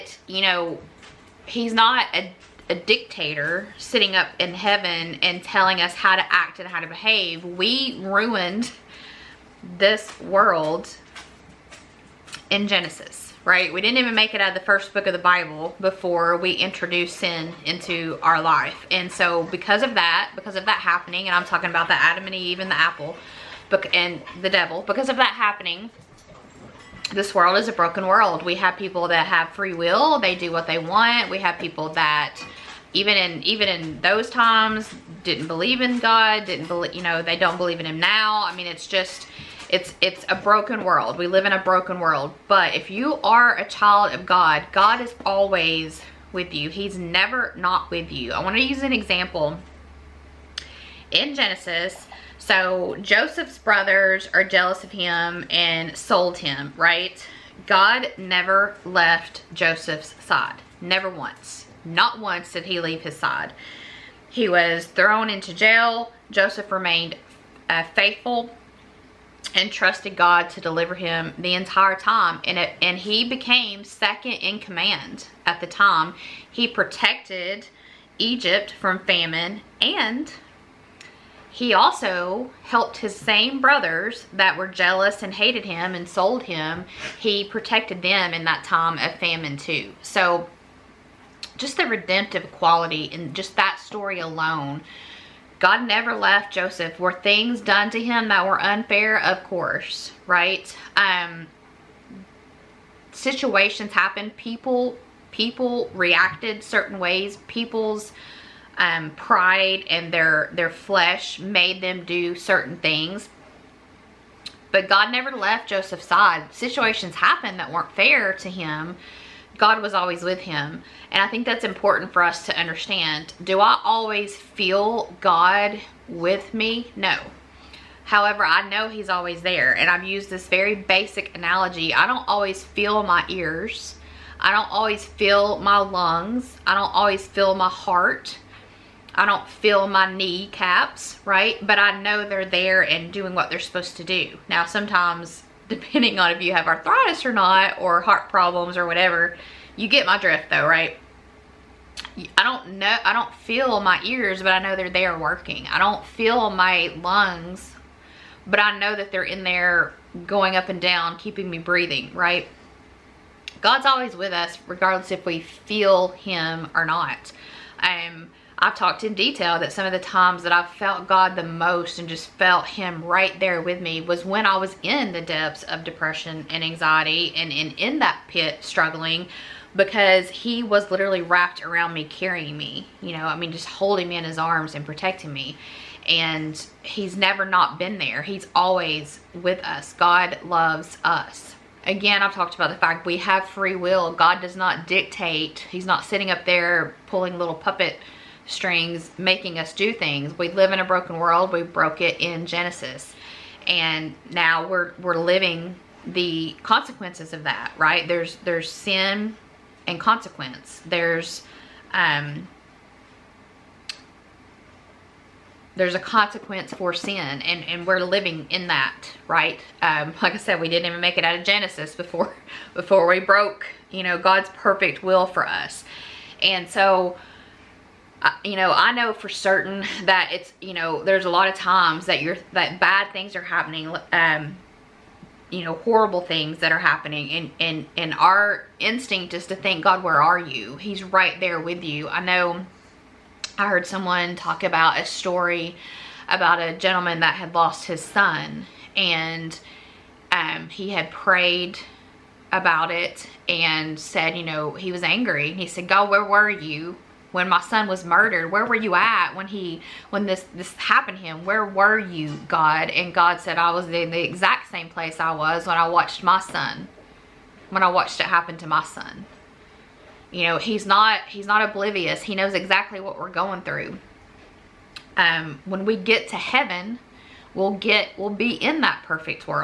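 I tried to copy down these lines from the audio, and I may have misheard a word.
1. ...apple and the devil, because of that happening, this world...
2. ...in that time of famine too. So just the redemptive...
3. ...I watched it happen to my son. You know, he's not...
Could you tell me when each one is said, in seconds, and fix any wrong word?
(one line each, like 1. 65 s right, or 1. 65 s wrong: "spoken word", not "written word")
1. 22 s right
2. 88 s right
3. 267 s right.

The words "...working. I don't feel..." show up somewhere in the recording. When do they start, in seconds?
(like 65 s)
155 s.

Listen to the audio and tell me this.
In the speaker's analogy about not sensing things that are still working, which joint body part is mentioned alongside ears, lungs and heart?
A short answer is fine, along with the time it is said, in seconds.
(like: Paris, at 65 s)
Knee caps, at 140 s.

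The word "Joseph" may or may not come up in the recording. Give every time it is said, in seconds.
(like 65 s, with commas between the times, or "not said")
52 s, 59 s, 66 s, 96 s, 115 s.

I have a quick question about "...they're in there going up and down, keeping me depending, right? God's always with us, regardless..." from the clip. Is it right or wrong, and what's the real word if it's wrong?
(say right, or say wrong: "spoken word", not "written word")
wrong: "breathing", not "depending".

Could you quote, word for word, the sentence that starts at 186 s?
And He's never not been there, He's always with us.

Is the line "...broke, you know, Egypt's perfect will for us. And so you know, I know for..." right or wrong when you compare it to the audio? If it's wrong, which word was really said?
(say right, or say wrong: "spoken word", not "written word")
wrong: "God", not "Egypt".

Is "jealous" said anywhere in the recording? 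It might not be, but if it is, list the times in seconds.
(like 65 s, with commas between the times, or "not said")
54 s, 84 s.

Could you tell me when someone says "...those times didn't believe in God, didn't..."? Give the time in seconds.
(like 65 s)
34 s.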